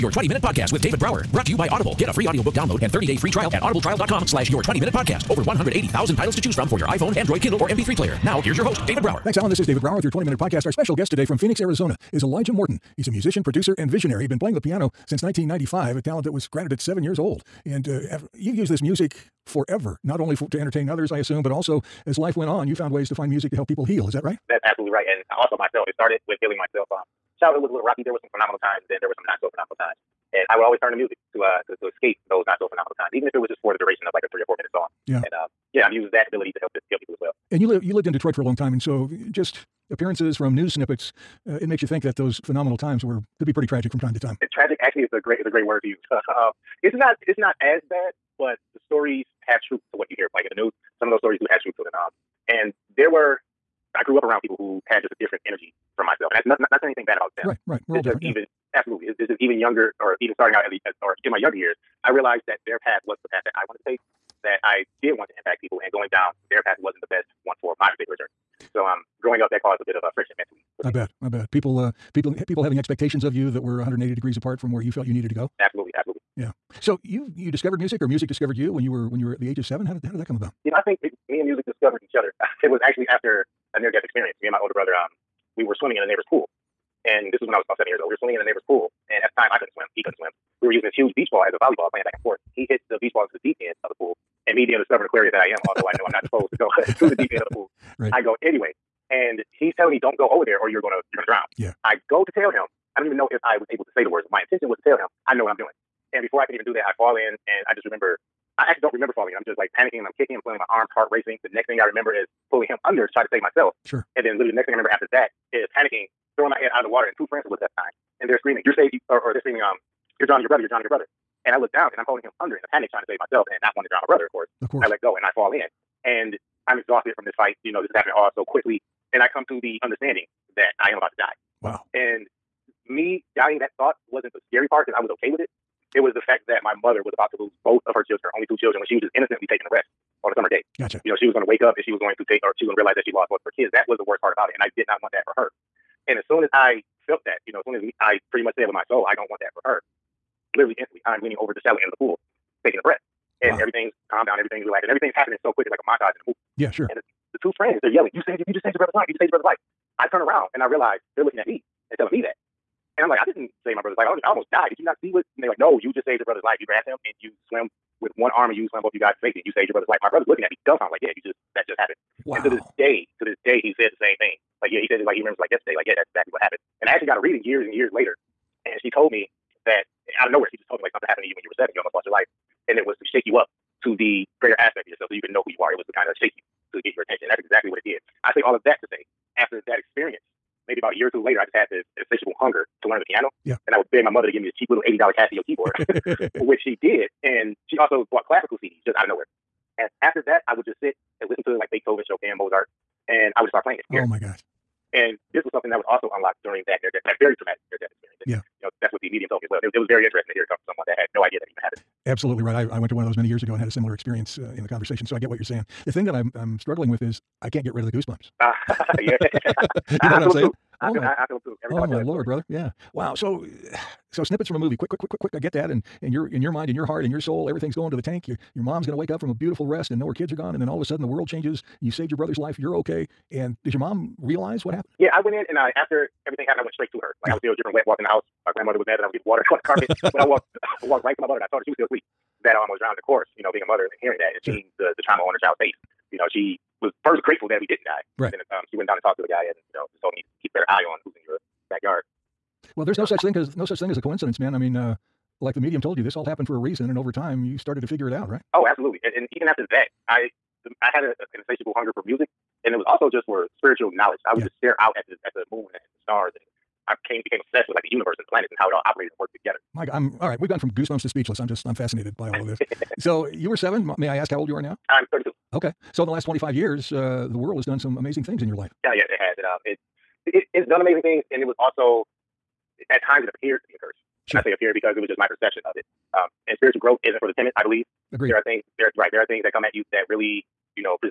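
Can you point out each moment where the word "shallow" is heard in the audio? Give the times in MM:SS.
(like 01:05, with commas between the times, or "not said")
02:31.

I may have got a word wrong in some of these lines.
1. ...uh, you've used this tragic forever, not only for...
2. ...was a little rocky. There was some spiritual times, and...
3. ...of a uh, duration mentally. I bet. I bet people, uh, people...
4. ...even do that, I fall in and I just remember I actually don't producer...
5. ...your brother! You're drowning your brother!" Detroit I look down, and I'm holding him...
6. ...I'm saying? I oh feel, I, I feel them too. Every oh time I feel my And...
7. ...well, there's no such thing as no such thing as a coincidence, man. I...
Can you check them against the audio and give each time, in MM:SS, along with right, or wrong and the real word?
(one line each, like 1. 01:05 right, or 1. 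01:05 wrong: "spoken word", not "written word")
1. 00:17 wrong: "music", not "tragic"
2. 00:27 wrong: "phenomenal", not "spiritual"
3. 01:09 wrong: "friction", not "duration"
4. 01:46 wrong: "remember", not "producer"
5. 02:00 wrong: "And", not "Detroit"
6. 03:40 wrong: "Lord", not "And"
7. 04:12 right.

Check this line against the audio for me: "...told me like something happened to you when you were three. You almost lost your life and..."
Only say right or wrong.
wrong.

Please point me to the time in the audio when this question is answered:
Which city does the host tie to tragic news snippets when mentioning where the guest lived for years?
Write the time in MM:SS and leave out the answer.
00:38.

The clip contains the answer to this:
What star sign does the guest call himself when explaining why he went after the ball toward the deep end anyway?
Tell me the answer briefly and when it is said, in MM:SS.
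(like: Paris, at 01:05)
Aquarius, at 01:35.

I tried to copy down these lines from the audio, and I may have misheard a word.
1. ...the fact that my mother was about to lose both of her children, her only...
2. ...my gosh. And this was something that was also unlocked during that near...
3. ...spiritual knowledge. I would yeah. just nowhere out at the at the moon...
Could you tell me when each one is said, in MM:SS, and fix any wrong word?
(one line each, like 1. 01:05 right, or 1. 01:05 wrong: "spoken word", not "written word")
1. 02:16 right
2. 03:24 right
3. 04:23 wrong: "stare", not "nowhere".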